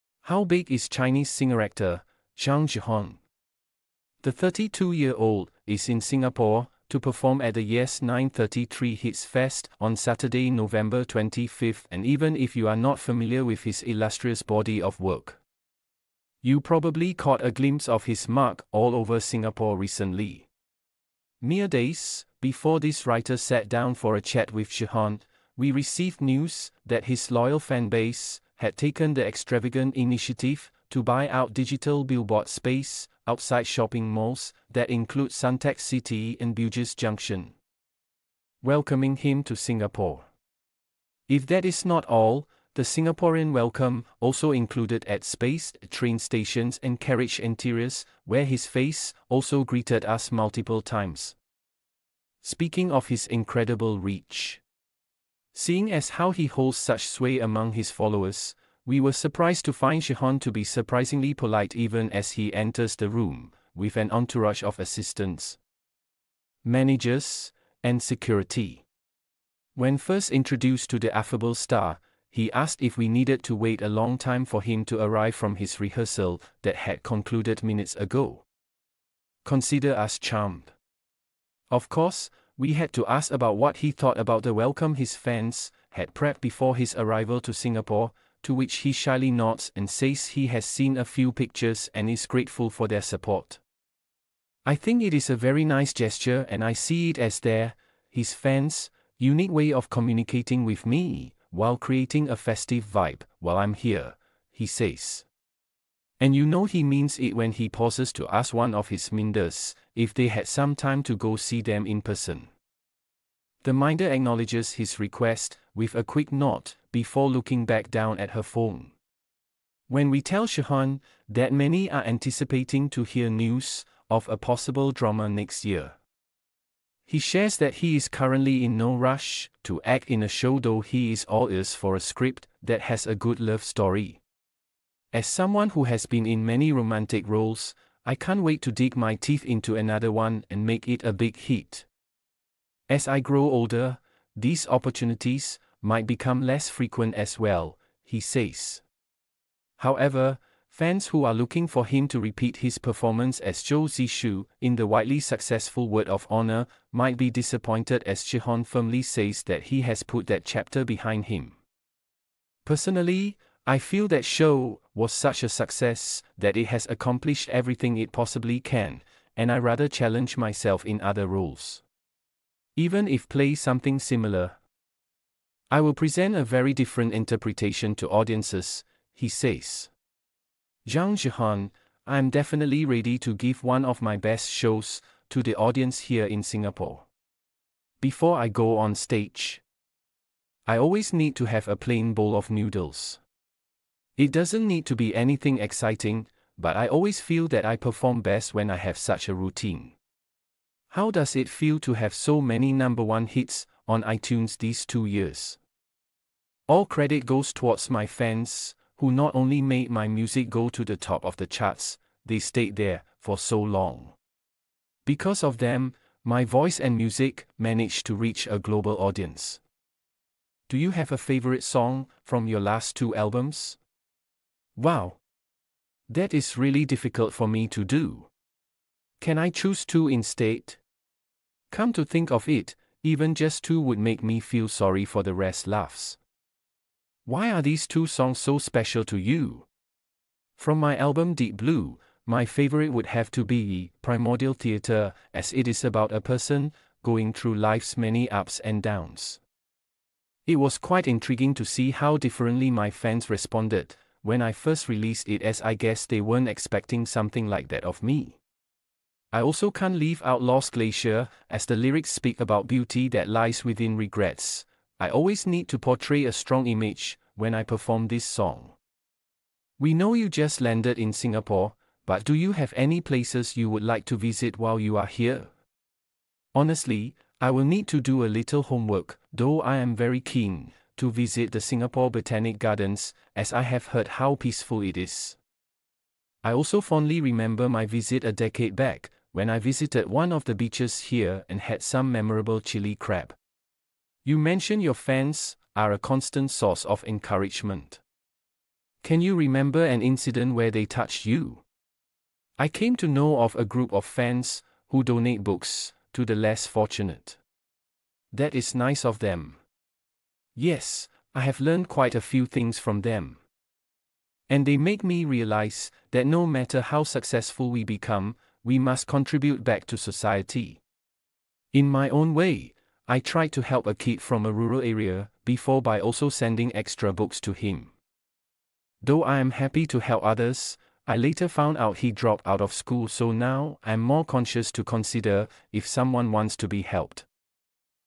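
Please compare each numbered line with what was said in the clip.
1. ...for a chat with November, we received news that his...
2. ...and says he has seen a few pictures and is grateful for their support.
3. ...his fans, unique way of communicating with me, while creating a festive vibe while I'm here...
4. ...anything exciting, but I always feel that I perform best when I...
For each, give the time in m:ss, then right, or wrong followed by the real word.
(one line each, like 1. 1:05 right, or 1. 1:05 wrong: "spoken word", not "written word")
1. 0:23 wrong: "Zhehan", not "November"
2. 1:29 right
3. 1:38 right
4. 3:15 right.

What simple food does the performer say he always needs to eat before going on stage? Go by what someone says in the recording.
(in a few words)
plain bowl of noodles.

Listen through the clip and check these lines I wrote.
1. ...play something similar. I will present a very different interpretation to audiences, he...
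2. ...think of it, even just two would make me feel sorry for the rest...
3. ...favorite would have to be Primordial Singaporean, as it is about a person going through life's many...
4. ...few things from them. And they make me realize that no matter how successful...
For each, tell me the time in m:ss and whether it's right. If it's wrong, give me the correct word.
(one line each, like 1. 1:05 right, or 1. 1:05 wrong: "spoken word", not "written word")
1. 2:53 right
2. 3:52 right
3. 4:02 wrong: "Theater", not "Singaporean"
4. 5:12 right.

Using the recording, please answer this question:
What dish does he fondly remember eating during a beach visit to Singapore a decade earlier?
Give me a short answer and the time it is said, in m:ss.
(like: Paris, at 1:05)
chili crab, at 4:52.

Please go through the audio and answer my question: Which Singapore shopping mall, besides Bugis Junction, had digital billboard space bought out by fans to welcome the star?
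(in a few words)
Suntec City.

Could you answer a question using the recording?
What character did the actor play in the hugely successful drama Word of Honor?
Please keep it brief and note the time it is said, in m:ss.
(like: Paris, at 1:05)
Zhou Zishu, at 2:33.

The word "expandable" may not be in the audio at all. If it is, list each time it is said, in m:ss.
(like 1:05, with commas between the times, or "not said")
not said.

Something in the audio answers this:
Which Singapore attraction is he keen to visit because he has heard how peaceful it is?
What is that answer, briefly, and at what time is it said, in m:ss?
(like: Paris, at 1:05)
Singapore Botanic Gardens, at 4:41.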